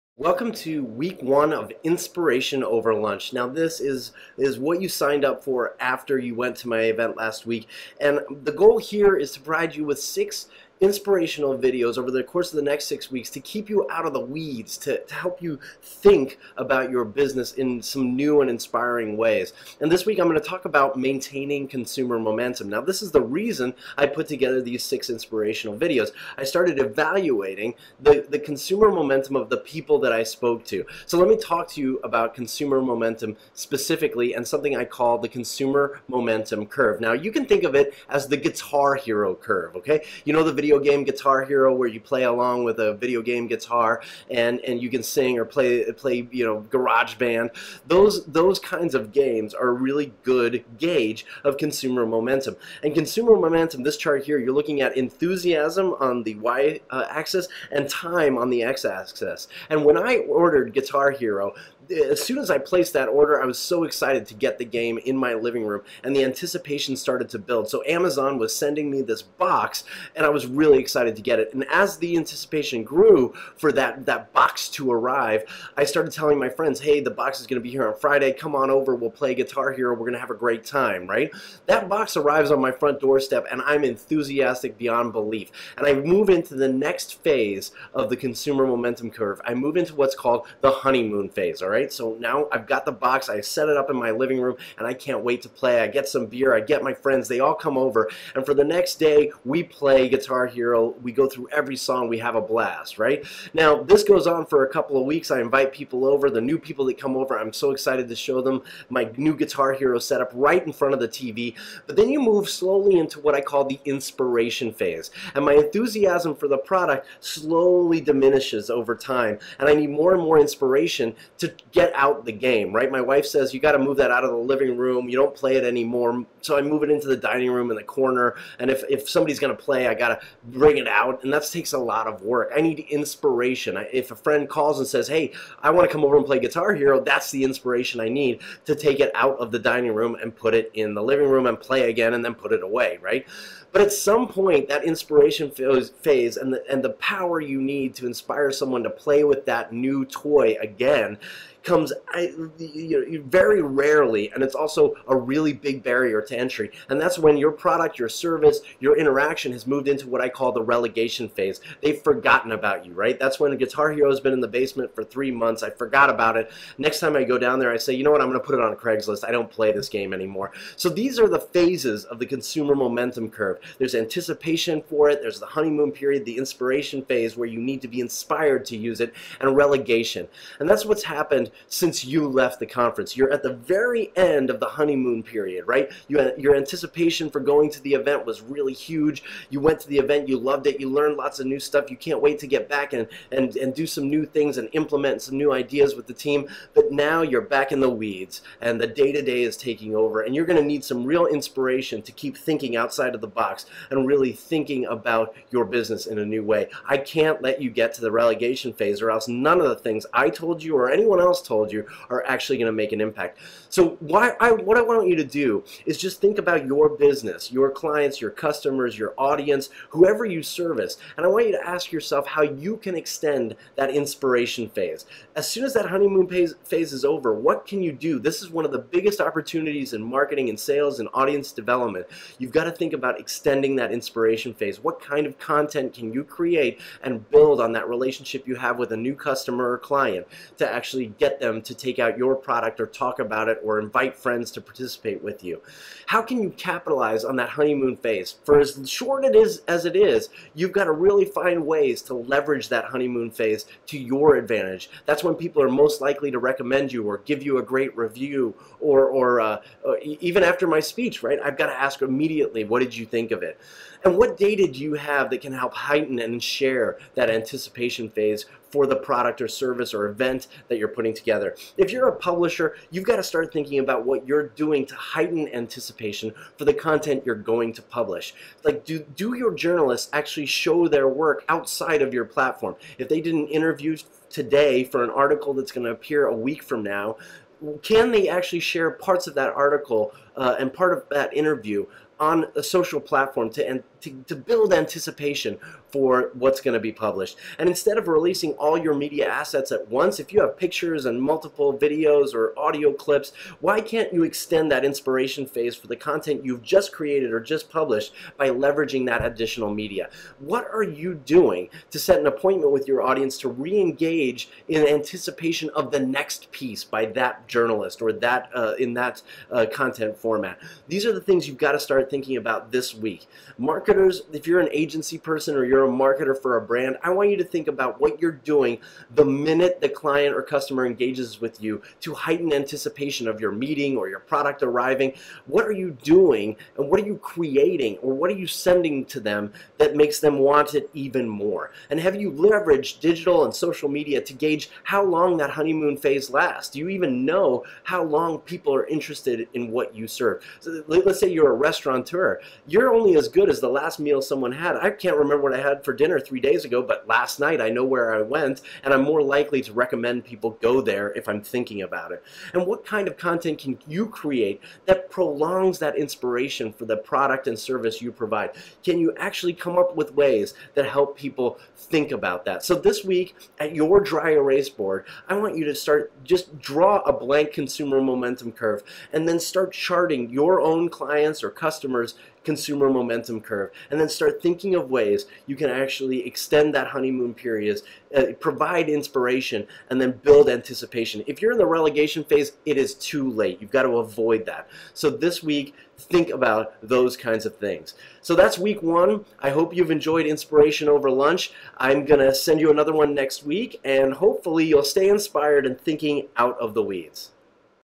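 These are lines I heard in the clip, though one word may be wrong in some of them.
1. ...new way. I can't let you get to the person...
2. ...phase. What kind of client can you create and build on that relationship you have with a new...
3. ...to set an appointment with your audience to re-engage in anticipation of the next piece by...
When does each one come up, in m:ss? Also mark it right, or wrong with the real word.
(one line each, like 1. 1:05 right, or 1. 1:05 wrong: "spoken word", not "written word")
1. 3:26 wrong: "relegation", not "person"
2. 3:54 wrong: "content", not "client"
3. 5:11 right.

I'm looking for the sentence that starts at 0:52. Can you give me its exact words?
And consumer momentum, this chart here, you're looking at enthusiasm on the y uh, axis and time on the x axis.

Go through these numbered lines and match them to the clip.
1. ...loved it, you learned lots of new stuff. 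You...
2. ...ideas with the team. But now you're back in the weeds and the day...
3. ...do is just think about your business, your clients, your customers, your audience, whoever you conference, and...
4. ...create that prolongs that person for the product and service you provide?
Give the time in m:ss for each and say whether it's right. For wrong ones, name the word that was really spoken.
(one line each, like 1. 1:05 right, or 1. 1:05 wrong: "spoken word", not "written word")
1. 3:10 right
2. 3:15 right
3. 3:35 wrong: "service", not "conference"
4. 6:04 wrong: "inspiration", not "person".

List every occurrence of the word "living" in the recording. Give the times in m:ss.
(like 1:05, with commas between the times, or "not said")
1:05, 1:34, 2:04, 2:21.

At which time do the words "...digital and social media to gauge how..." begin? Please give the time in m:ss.
5:42.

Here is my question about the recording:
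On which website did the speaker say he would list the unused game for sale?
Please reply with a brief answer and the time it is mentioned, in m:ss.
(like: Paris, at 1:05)
Craigslist, at 2:48.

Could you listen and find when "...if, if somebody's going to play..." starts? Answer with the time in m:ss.
2:08.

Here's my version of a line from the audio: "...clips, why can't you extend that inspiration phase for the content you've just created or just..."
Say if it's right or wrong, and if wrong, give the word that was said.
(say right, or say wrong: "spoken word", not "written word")
right.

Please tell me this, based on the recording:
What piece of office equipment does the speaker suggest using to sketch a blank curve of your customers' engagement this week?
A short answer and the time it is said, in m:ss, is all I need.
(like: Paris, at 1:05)
Dry erase board, at 6:14.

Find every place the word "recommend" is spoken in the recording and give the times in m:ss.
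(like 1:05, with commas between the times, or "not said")
4:16, 5:59.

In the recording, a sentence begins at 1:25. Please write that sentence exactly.
And I move into the next phase of the consumer momentum curve.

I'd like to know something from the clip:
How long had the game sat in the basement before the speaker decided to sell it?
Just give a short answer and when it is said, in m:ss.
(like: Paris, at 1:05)
Three months, at 2:45.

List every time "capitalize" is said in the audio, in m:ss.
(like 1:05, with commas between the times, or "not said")
4:06.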